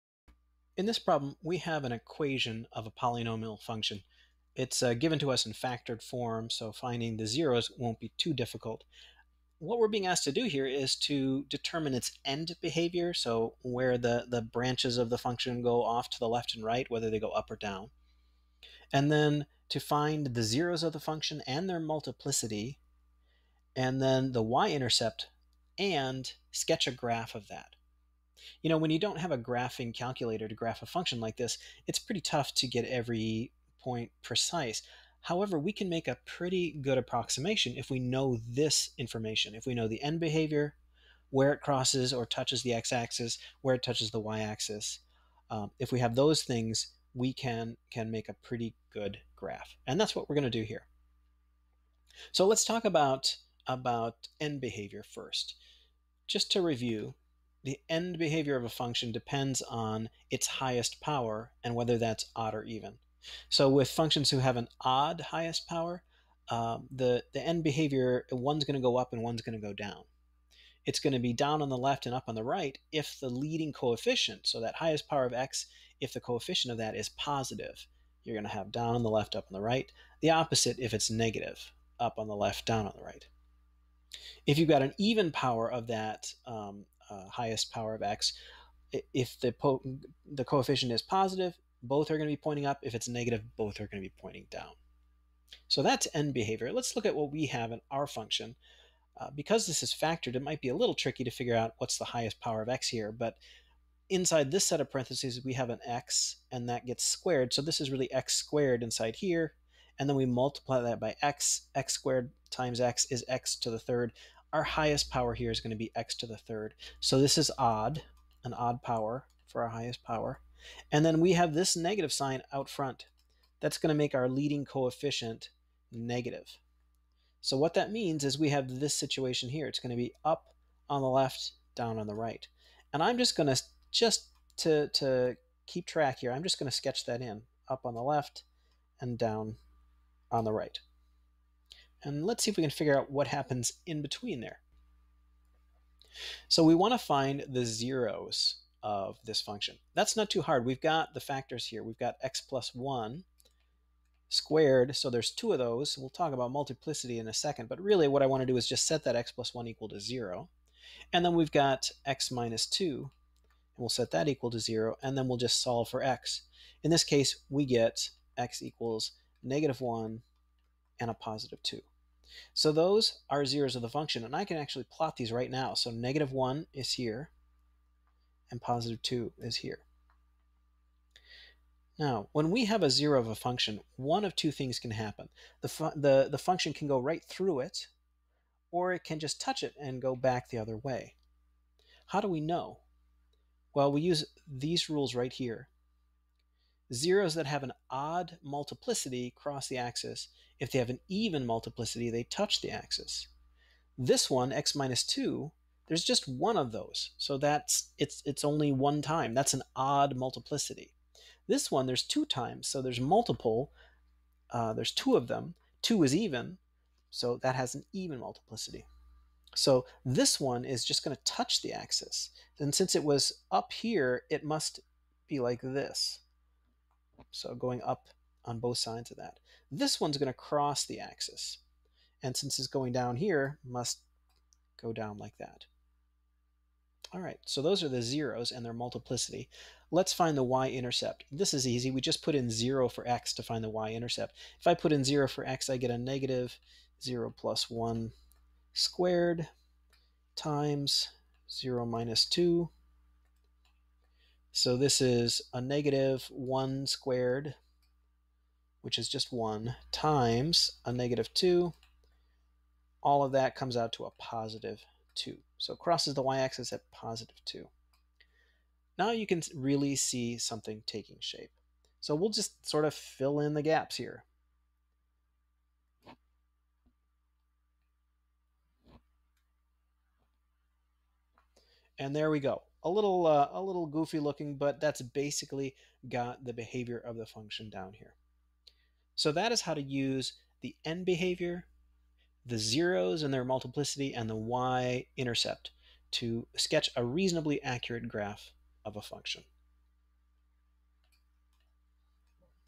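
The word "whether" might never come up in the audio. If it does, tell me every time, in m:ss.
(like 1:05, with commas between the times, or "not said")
0:16, 1:01.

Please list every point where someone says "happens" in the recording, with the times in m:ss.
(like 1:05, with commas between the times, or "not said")
2:23, 3:04.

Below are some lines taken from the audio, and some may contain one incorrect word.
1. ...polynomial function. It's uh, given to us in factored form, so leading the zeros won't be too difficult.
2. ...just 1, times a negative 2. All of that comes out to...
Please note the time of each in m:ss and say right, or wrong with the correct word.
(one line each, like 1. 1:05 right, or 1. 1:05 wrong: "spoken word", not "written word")
1. 0:02 wrong: "finding", not "leading"
2. 4:19 right.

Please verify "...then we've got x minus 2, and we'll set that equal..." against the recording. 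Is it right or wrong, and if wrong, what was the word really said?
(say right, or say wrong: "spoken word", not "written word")
right.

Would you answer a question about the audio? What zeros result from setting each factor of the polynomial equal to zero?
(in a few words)
-1 and 2.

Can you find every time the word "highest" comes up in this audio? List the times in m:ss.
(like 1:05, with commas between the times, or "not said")
1:00, 1:05, 1:14, 1:27, 1:42, 1:54, 1:59.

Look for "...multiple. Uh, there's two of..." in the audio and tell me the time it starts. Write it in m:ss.
3:33.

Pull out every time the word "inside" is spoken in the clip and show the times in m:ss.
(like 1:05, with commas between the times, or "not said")
1:44, 1:48.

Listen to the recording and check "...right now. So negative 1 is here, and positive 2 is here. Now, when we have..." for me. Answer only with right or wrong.
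right.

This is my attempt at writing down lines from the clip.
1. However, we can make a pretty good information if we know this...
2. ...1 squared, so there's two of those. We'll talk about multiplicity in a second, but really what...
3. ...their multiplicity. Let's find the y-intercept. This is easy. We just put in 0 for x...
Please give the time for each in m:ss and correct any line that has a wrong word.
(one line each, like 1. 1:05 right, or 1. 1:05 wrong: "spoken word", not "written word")
1. 0:35 wrong: "approximation", not "information"
2. 2:32 right
3. 3:58 right.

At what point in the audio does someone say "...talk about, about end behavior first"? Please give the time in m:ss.
0:52.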